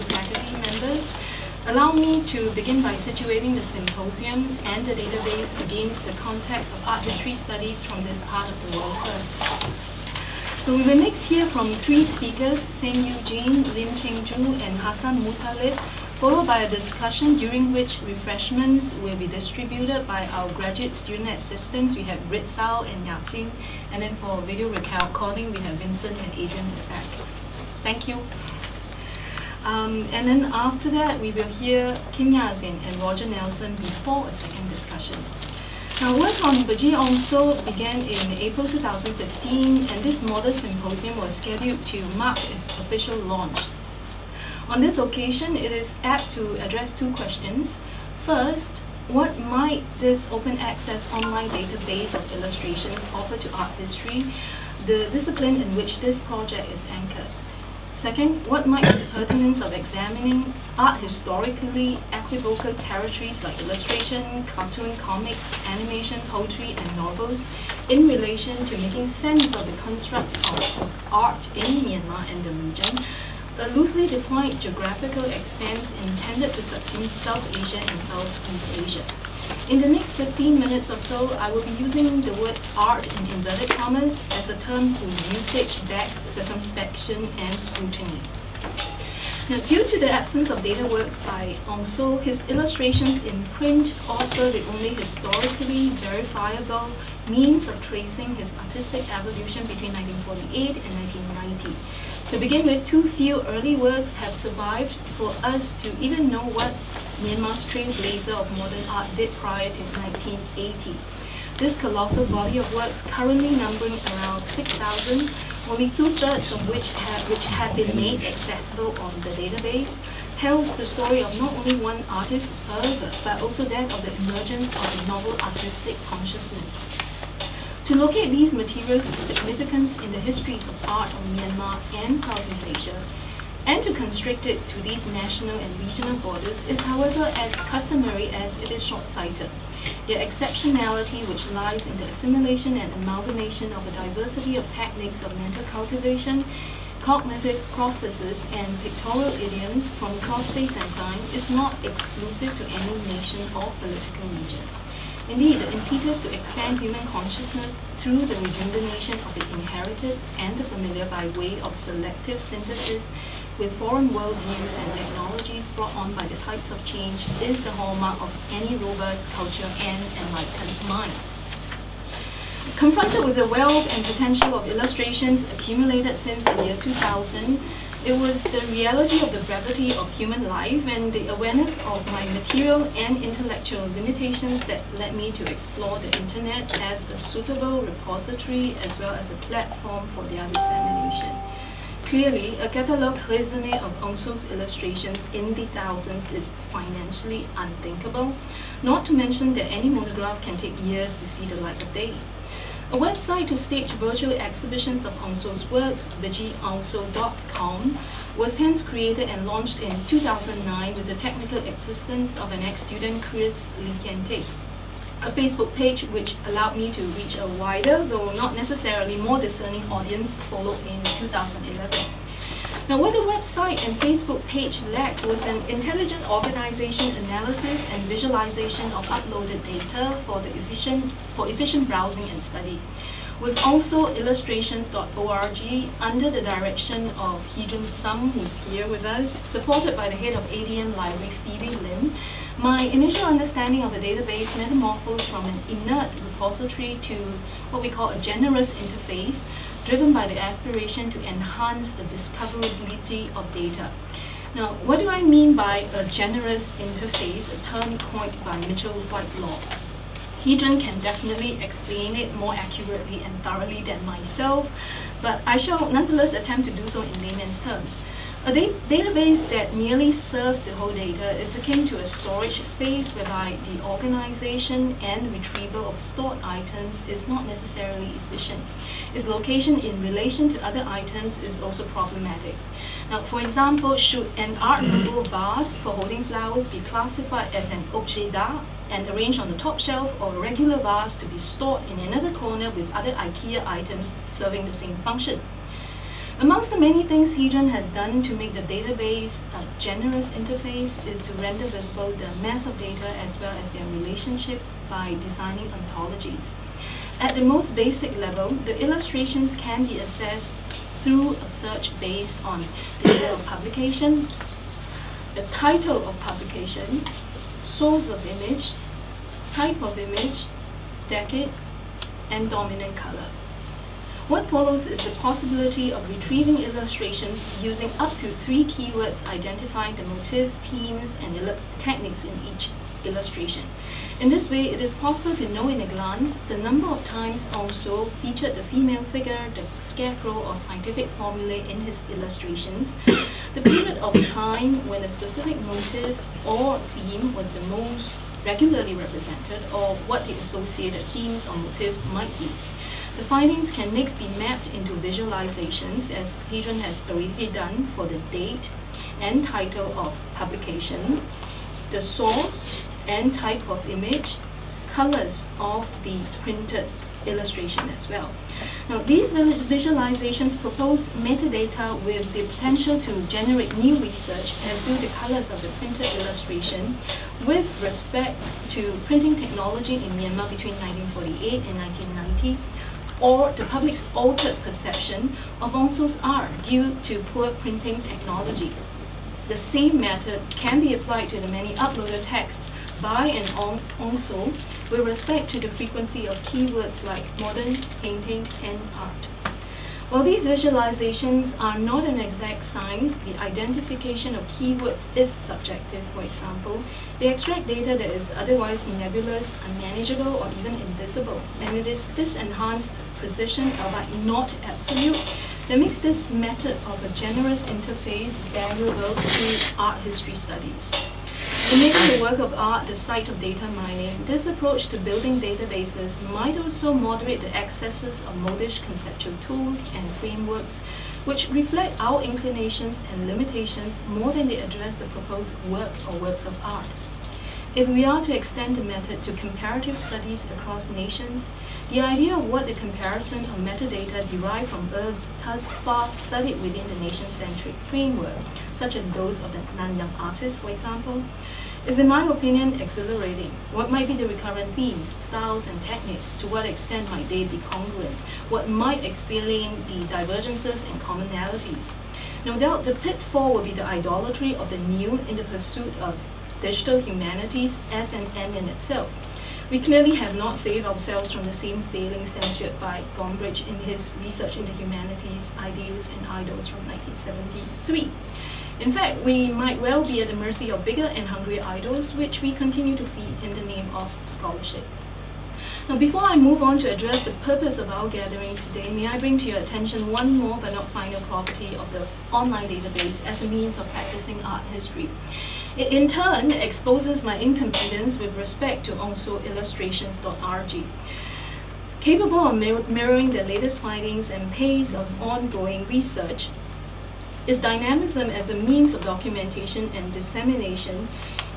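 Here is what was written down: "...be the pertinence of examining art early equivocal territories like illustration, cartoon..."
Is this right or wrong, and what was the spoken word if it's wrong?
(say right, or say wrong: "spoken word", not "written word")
wrong: "historically", not "early".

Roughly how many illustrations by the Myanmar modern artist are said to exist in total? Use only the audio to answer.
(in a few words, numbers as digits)
6,000.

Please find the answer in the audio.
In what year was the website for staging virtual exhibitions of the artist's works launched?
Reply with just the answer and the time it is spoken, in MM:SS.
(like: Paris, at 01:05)
2009, at 03:30.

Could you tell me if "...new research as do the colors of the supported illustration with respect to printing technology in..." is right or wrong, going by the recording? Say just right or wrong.
wrong.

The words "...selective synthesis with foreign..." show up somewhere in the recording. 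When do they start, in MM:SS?
02:41.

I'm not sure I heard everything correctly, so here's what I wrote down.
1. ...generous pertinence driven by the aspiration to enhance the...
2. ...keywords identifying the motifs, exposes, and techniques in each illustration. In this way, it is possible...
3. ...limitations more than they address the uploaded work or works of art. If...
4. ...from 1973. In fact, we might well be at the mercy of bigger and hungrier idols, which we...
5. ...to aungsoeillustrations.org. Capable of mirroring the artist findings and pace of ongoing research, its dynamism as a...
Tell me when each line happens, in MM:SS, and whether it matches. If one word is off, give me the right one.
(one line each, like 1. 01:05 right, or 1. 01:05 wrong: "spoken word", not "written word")
1. 04:08 wrong: "interface", not "pertinence"
2. 05:28 wrong: "themes", not "exposes"
3. 07:13 wrong: "proposed", not "uploaded"
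4. 07:56 right
5. 08:18 wrong: "latest", not "artist".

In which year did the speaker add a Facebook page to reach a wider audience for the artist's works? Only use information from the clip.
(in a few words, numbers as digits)
2011.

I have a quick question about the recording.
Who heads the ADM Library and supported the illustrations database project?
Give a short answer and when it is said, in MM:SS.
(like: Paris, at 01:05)
Phoebe Lim, at 04:01.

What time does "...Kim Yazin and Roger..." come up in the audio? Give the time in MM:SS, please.
00:32.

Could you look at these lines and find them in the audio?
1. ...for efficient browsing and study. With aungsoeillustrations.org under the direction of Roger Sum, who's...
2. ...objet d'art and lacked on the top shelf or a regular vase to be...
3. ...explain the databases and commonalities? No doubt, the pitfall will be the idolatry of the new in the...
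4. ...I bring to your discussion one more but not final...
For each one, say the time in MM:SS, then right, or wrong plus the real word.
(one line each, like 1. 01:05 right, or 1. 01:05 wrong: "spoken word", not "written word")
1. 03:51 wrong: "Heejun", not "Roger"
2. 04:47 wrong: "arranged", not "lacked"
3. 07:39 wrong: "divergences", not "databases"
4. 08:09 wrong: "attention", not "discussion".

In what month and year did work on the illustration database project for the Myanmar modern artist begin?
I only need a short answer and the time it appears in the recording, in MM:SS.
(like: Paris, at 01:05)
April 2015, at 00:38.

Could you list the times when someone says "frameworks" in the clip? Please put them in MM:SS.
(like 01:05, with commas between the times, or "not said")
07:10, 07:27.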